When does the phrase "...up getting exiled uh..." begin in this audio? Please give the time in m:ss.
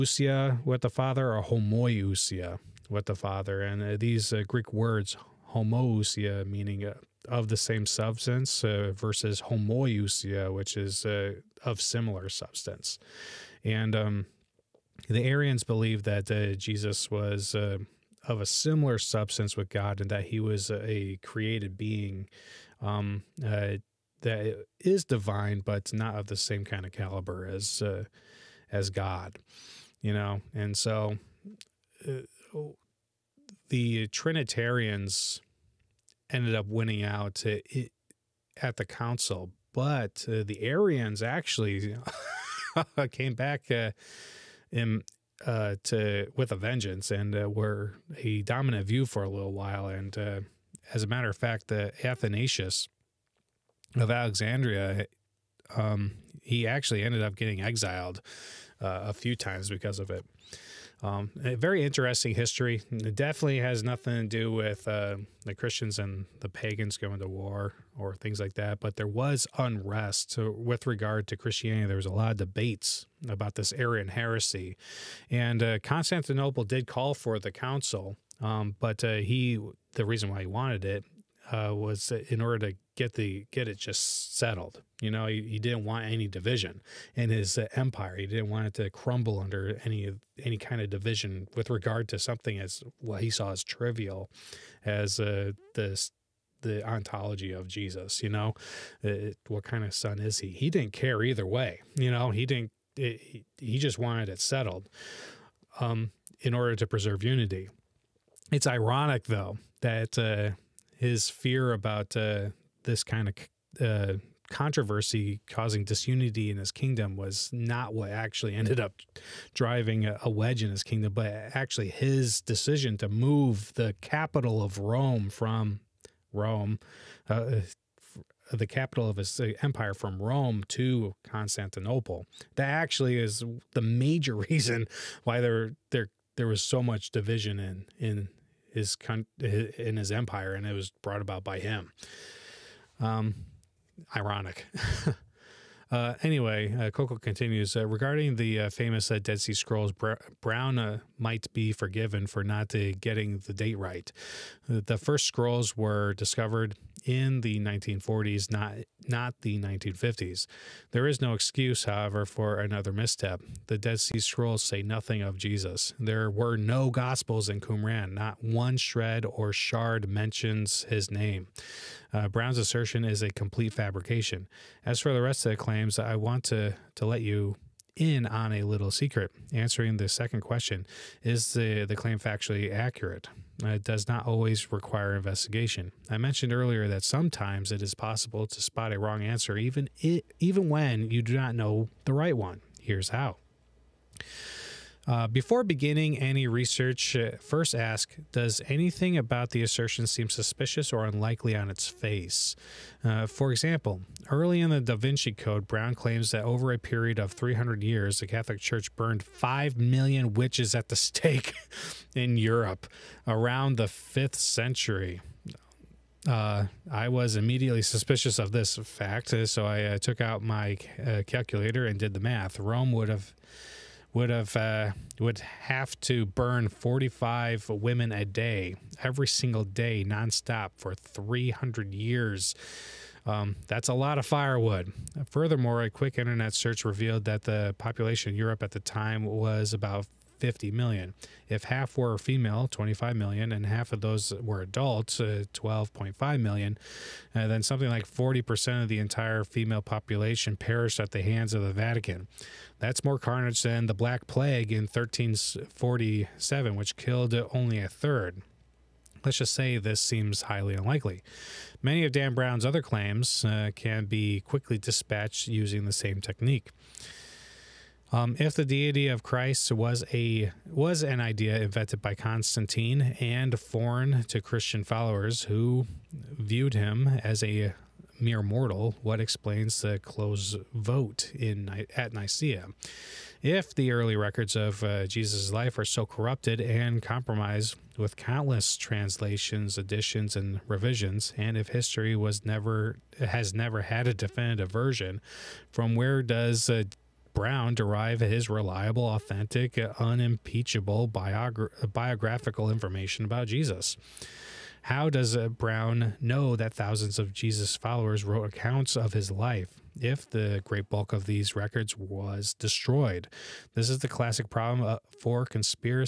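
0:57.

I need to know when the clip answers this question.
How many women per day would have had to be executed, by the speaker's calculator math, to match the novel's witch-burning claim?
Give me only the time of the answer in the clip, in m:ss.
3:46.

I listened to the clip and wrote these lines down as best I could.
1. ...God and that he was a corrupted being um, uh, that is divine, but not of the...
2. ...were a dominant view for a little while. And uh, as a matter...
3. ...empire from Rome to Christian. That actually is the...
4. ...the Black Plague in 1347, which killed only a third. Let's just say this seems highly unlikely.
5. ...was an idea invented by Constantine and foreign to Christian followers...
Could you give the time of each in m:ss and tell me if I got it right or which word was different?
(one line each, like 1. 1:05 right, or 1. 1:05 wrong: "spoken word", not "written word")
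1. 0:19 wrong: "created", not "corrupted"
2. 0:47 right
3. 2:09 wrong: "Constantinople", not "Christian"
4. 4:13 right
5. 4:30 right.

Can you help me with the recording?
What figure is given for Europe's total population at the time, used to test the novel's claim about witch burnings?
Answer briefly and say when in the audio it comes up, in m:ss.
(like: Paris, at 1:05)
50 million, at 4:00.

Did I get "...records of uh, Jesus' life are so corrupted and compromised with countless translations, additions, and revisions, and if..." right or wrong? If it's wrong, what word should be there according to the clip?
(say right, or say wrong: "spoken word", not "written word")
right.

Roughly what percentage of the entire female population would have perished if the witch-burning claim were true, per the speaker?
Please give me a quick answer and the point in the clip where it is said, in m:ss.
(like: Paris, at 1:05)
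40%, at 4:08.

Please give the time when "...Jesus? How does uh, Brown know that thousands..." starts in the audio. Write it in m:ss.
5:03.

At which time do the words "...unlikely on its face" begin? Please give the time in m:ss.
3:21.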